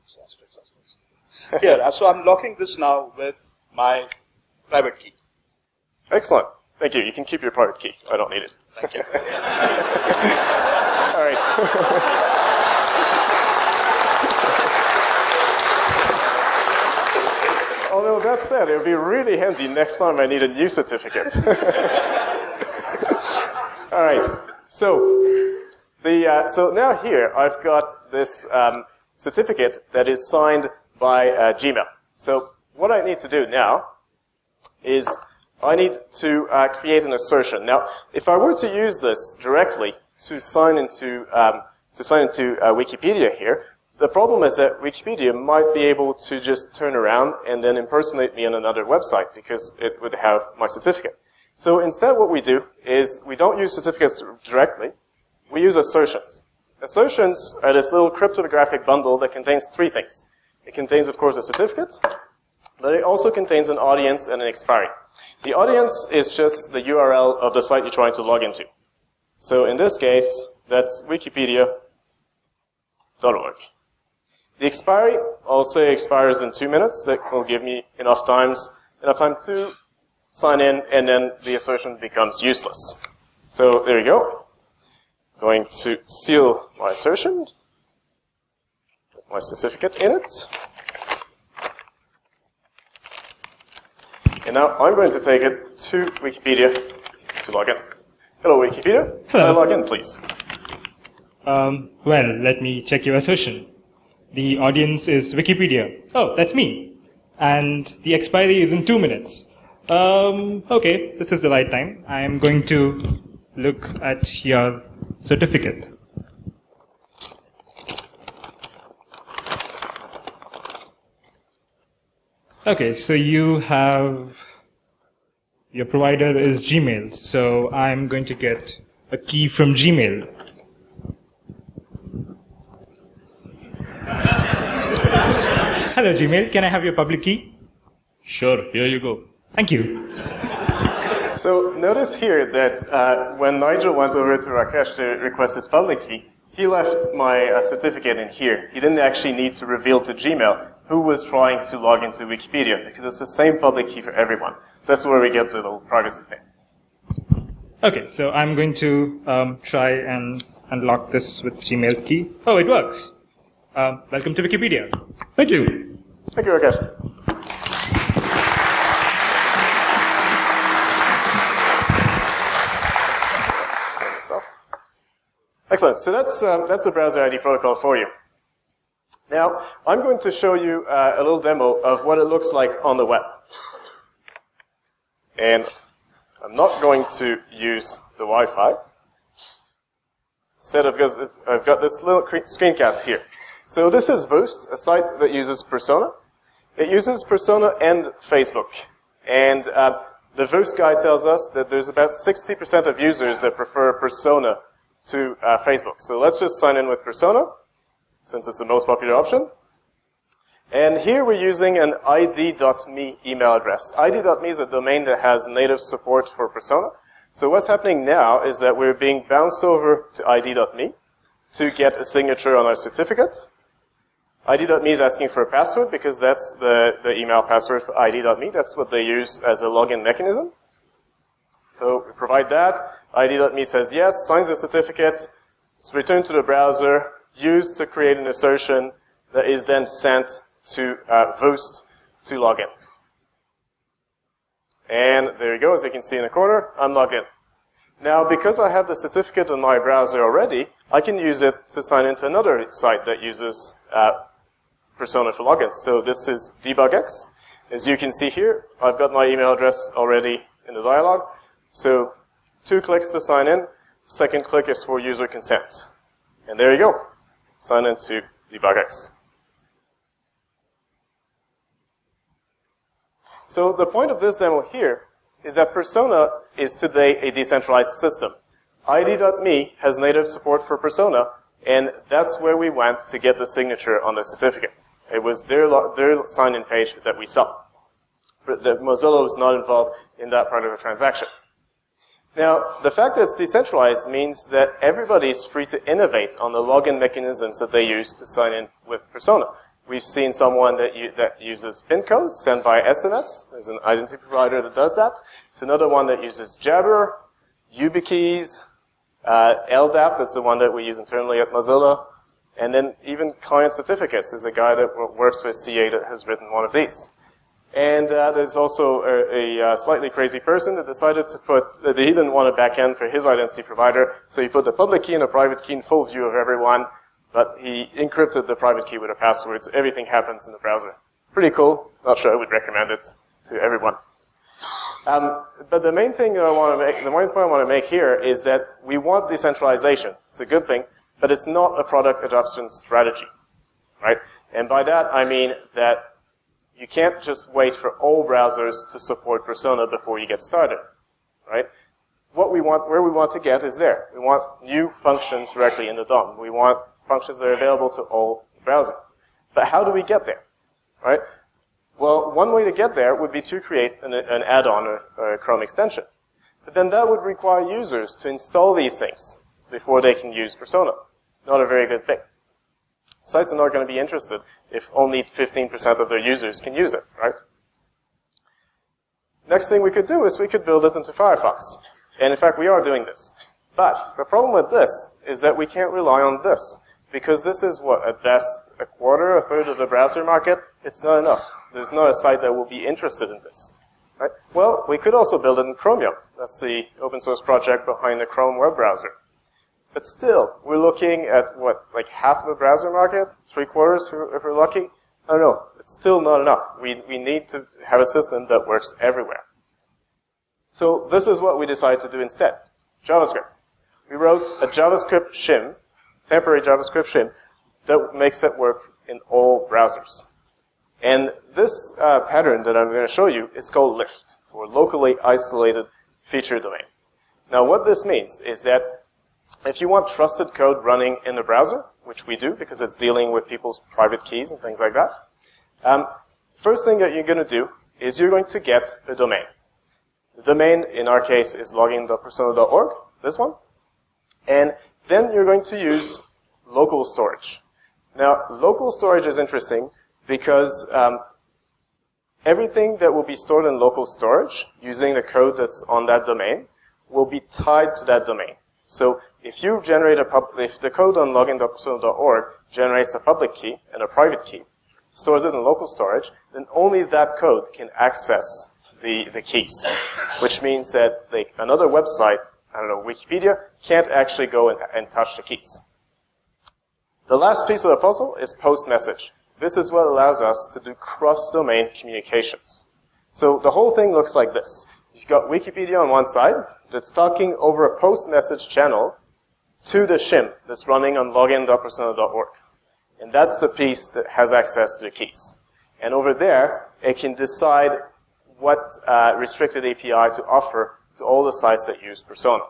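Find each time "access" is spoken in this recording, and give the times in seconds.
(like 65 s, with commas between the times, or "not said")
467 s, 494 s.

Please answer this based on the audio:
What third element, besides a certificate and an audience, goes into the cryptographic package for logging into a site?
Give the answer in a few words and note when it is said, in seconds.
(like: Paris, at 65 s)
An expiry, at 64 s.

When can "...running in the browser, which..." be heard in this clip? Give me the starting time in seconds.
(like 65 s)
430 s.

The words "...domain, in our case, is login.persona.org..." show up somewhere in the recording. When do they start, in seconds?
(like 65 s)
440 s.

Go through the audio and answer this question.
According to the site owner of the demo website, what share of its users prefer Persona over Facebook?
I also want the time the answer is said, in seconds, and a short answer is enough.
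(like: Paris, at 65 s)
60%, at 202 s.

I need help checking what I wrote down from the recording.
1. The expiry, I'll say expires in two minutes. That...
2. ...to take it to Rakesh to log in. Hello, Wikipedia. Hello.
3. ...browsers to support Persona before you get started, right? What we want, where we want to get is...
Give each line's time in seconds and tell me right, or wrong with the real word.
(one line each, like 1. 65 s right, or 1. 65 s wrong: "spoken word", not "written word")
1. 74 s right
2. 95 s wrong: "Wikipedia", not "Rakesh"
3. 348 s right.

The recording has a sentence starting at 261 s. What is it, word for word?
So two clicks to sign in, second click is for user consent.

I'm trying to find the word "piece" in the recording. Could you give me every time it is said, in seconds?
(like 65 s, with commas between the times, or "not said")
477 s, 493 s.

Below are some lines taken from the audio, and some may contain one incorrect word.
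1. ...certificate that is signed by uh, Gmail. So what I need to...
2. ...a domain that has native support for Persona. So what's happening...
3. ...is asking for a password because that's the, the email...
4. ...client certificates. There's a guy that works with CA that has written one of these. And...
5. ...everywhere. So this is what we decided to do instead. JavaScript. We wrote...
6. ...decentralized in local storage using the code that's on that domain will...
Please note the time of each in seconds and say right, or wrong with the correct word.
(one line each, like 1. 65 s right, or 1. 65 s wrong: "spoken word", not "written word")
1. 29 s right
2. 214 s right
3. 224 s right
4. 313 s right
5. 408 s right
6. 453 s wrong: "stored", not "decentralized".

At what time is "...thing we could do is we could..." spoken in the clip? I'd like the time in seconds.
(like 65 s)
379 s.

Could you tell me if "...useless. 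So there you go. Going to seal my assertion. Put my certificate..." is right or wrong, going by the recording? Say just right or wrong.
right.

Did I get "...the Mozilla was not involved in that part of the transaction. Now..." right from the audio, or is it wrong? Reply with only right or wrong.
right.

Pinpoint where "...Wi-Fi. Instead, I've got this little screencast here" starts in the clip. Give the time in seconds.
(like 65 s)
188 s.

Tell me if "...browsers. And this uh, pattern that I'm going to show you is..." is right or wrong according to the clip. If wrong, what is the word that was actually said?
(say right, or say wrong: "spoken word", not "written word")
right.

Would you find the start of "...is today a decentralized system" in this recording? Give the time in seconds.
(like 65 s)
276 s.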